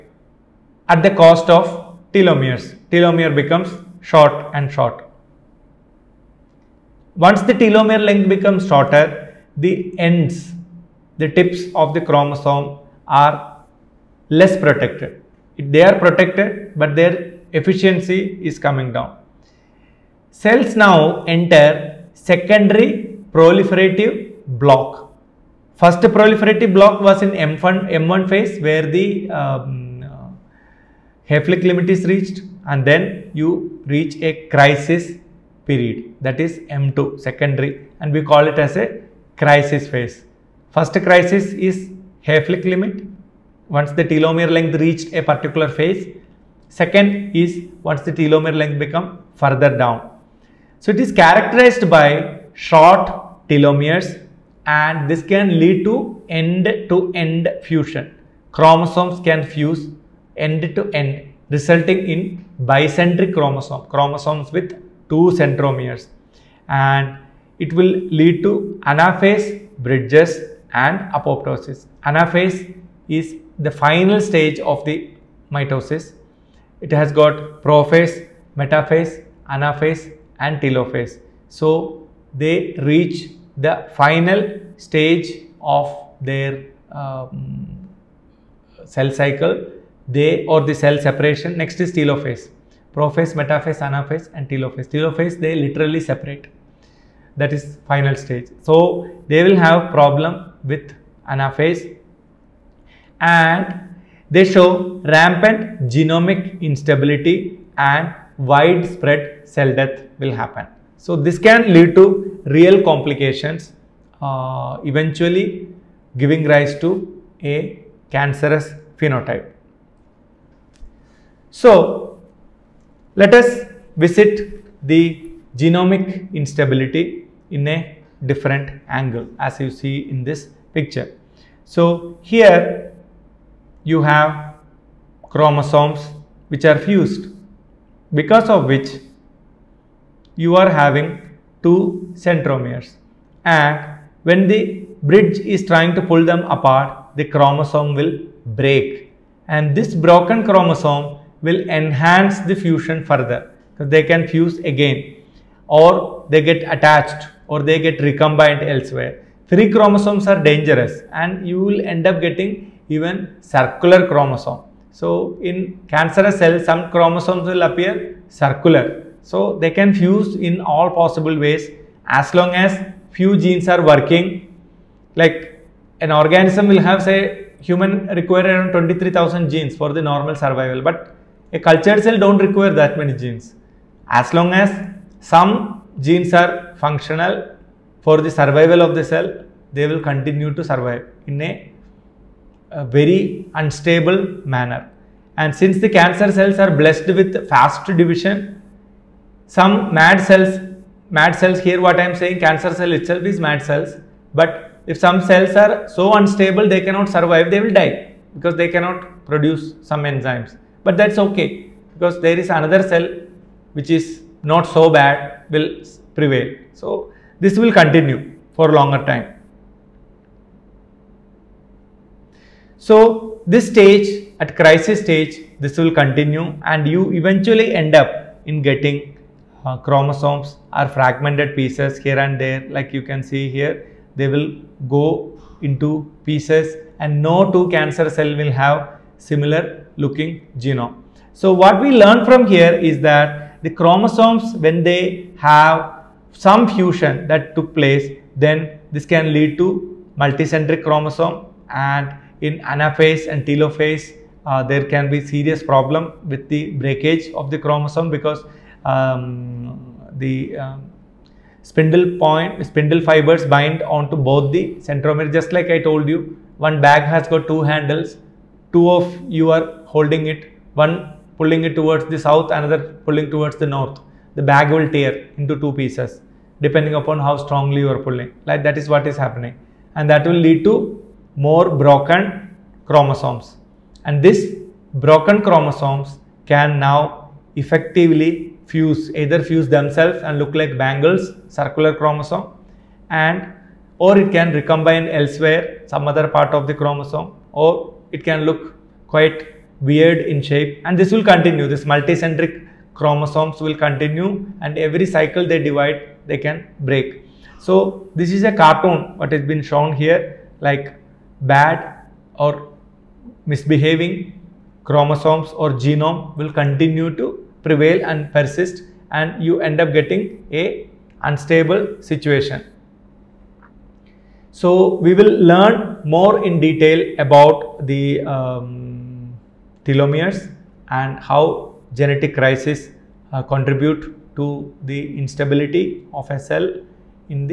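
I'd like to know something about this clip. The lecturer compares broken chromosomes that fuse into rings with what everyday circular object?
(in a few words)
bangles.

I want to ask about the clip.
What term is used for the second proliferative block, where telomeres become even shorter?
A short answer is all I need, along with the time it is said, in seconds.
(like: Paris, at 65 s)
crisis phase, at 39 s.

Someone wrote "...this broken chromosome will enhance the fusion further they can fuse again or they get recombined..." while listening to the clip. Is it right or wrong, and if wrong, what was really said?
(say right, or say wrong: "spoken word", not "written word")
wrong: "attached", not "recombined".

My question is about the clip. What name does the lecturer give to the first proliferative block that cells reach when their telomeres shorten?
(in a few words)
Hayflick limit.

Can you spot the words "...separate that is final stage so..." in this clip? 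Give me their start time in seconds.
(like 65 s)
95 s.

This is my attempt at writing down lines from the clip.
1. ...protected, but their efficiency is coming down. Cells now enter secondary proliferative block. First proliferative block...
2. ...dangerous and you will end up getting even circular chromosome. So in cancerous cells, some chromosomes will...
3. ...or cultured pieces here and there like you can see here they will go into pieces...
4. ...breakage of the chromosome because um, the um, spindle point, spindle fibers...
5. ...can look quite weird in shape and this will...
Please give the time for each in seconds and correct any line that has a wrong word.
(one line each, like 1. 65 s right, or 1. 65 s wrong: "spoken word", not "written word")
1. 15 s right
2. 160 s right
3. 230 s wrong: "fragmented", not "cultured"
4. 256 s right
5. 298 s right.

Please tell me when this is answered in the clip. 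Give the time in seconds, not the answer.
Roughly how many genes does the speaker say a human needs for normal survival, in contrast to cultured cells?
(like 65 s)
178 s.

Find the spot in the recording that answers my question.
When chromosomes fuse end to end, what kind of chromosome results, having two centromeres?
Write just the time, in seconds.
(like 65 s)
62 s.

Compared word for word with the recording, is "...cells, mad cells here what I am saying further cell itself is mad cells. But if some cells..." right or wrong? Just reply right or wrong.
wrong.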